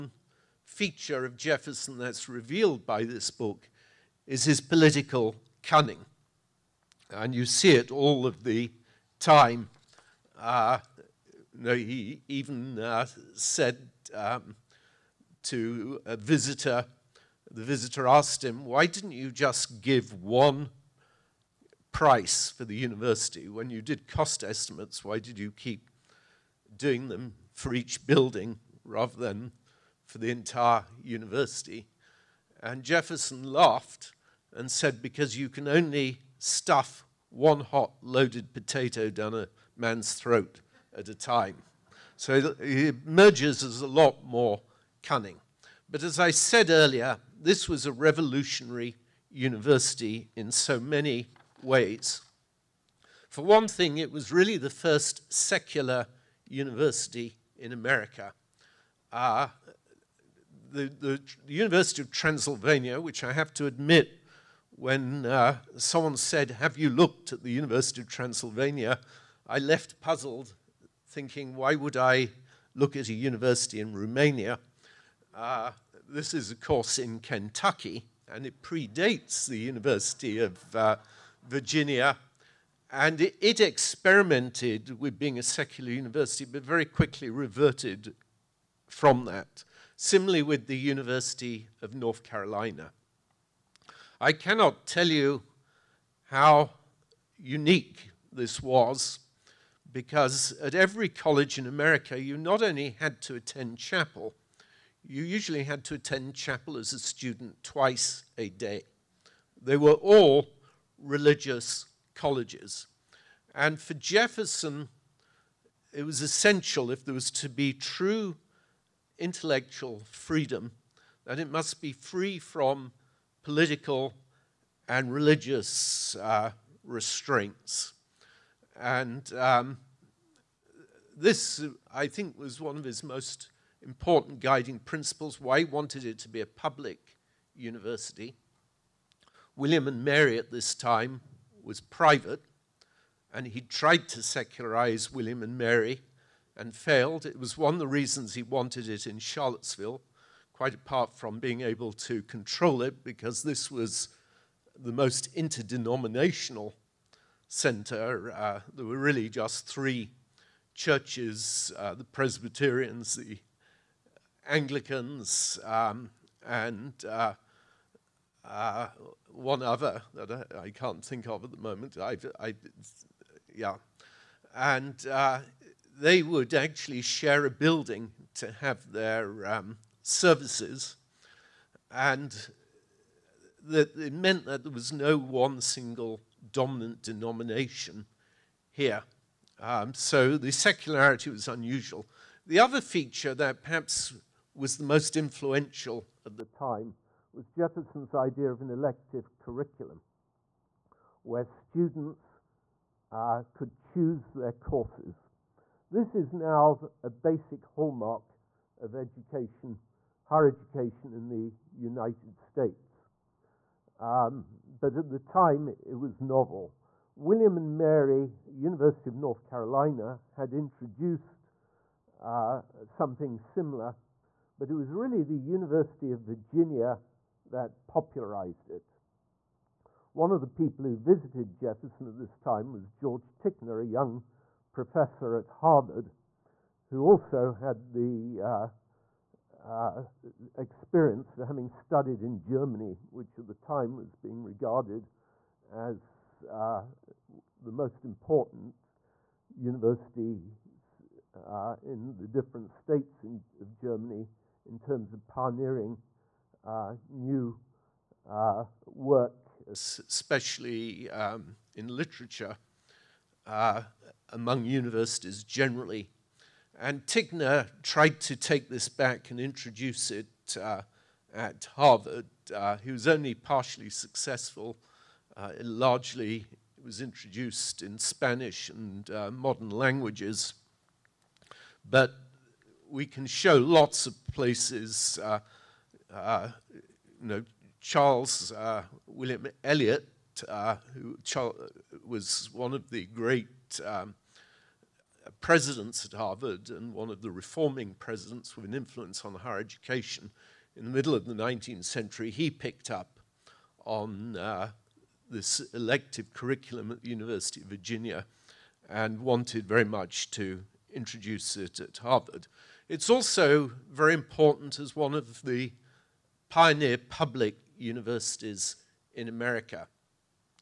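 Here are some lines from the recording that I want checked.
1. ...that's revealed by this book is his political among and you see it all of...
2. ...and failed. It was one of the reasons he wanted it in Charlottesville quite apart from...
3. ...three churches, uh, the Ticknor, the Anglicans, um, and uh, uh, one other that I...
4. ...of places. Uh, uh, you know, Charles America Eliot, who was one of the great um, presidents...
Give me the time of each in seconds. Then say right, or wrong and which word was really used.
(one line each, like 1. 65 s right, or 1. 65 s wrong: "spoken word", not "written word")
1. 1 s wrong: "cunning", not "among"
2. 146 s right
3. 159 s wrong: "Presbyterians", not "Ticknor"
4. 284 s wrong: "William", not "America".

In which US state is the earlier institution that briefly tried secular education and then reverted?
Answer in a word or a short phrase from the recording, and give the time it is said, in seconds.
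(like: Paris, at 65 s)
Kentucky, at 77 s.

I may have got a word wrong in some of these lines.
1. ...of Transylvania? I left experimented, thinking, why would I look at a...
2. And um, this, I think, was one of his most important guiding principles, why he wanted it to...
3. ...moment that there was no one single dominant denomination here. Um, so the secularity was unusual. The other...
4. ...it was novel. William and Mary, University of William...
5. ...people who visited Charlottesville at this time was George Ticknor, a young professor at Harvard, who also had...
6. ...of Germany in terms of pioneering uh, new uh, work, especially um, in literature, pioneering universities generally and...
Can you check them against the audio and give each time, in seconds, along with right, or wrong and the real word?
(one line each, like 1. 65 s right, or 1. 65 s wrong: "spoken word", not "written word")
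1. 67 s wrong: "puzzled", not "experimented"
2. 128 s right
3. 184 s wrong: "meant", not "moment"
4. 215 s wrong: "North", not "William"
5. 230 s wrong: "Jefferson", not "Charlottesville"
6. 253 s wrong: "among", not "pioneering".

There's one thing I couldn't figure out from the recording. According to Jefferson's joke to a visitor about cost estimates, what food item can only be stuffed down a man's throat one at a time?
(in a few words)
hot loaded potato.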